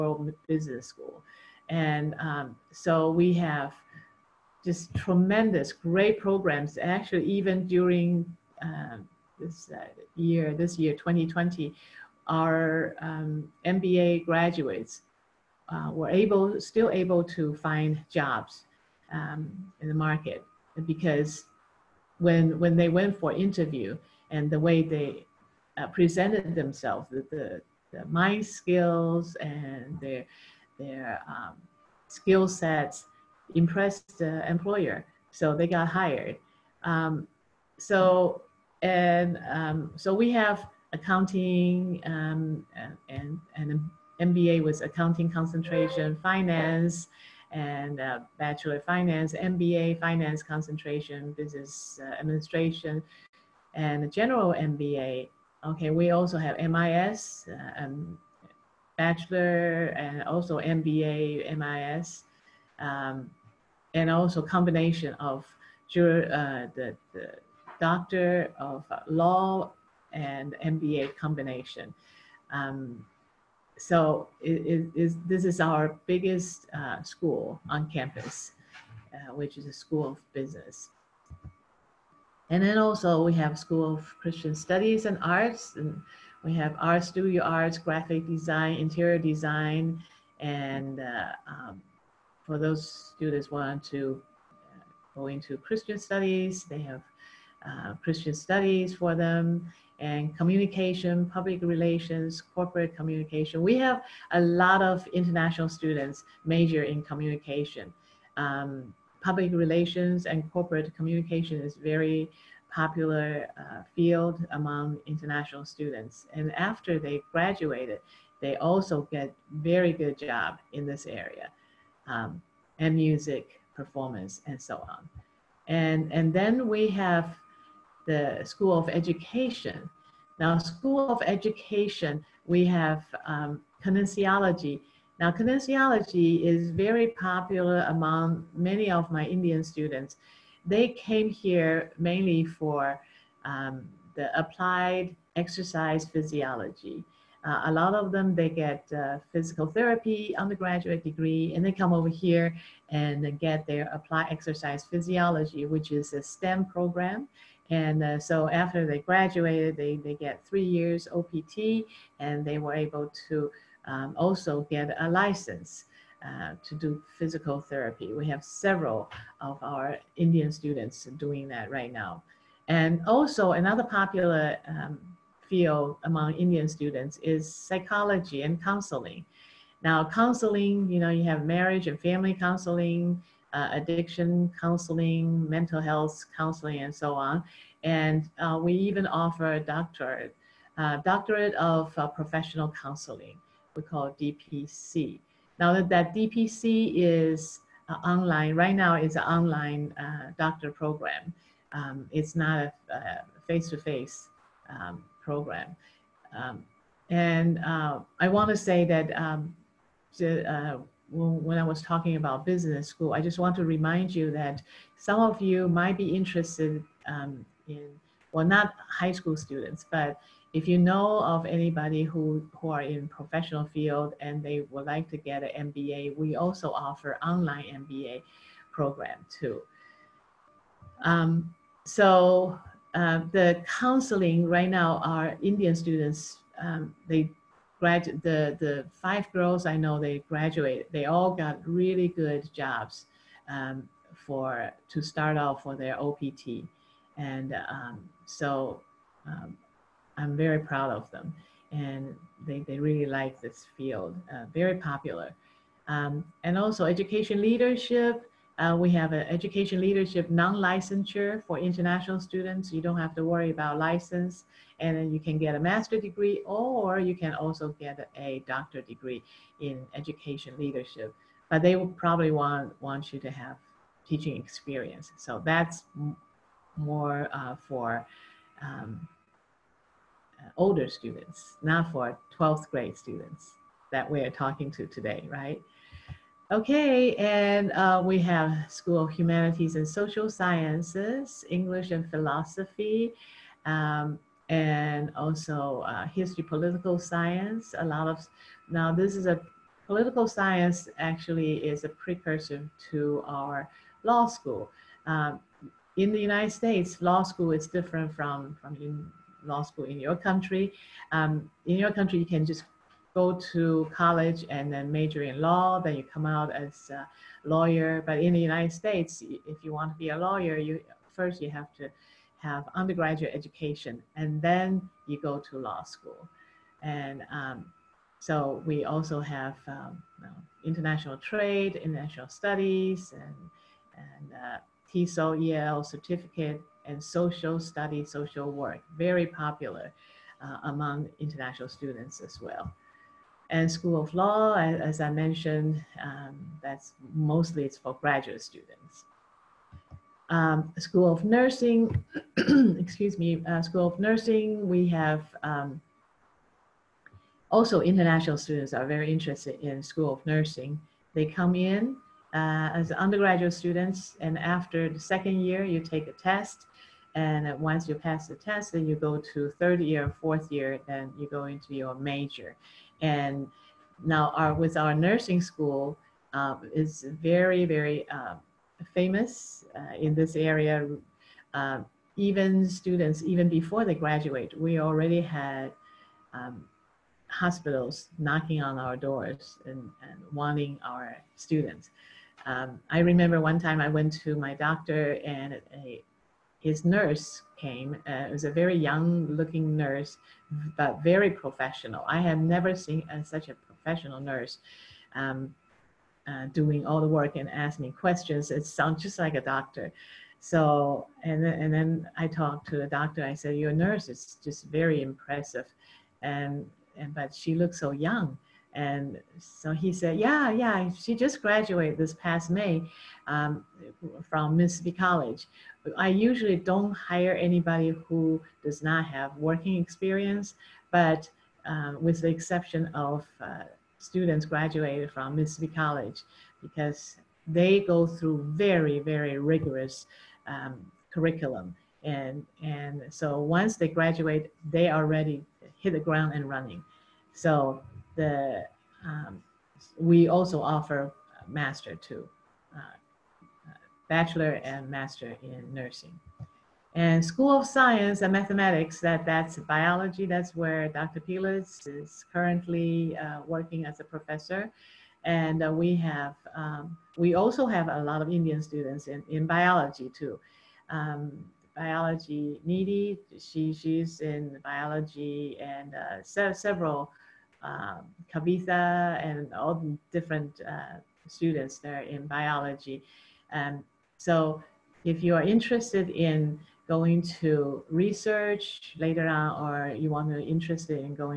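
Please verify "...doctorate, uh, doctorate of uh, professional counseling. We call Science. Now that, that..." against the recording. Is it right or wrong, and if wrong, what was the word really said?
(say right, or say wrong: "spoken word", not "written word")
wrong: "DPC", not "Science".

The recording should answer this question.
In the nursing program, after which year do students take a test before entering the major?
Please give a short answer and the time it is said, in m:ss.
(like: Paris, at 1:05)
Second year, at 6:04.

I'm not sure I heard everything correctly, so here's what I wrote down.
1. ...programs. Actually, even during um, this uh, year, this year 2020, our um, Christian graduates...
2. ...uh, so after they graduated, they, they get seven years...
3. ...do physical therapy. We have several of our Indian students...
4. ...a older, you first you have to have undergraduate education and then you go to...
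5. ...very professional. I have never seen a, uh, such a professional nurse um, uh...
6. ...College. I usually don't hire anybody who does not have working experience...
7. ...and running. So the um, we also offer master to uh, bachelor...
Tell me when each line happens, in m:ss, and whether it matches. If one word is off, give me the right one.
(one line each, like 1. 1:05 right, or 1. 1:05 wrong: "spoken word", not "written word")
1. 0:06 wrong: "MBA", not "Christian"
2. 2:38 wrong: "three", not "seven"
3. 2:46 right
4. 5:20 wrong: "lawyer", not "older"
5. 6:41 right
6. 7:04 right
7. 7:26 right.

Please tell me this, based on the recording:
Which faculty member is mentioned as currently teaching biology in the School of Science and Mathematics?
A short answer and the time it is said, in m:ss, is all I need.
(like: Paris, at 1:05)
Dr. Piletz, at 7:40.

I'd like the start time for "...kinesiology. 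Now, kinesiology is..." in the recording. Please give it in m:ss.
2:13.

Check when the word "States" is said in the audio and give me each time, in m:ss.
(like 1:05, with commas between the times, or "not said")
5:06, 5:18.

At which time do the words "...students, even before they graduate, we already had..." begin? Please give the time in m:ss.
6:22.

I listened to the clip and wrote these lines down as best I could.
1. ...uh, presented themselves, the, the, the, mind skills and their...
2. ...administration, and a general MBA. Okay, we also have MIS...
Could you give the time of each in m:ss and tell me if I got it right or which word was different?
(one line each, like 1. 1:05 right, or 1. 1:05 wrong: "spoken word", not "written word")
1. 0:25 right
2. 0:52 right.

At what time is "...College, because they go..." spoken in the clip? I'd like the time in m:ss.
7:15.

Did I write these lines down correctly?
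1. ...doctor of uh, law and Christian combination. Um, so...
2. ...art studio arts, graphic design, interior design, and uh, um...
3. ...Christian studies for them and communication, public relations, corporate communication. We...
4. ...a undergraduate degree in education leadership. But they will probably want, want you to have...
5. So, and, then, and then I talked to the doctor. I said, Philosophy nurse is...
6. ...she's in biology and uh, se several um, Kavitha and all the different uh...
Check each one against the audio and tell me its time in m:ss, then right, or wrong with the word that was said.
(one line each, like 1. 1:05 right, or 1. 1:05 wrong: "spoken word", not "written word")
1. 1:07 wrong: "MBA", not "Christian"
2. 1:26 right
3. 1:38 right
4. 4:28 wrong: "doctorate", not "undergraduate"
5. 6:50 wrong: "Your", not "Philosophy"
6. 7:53 right.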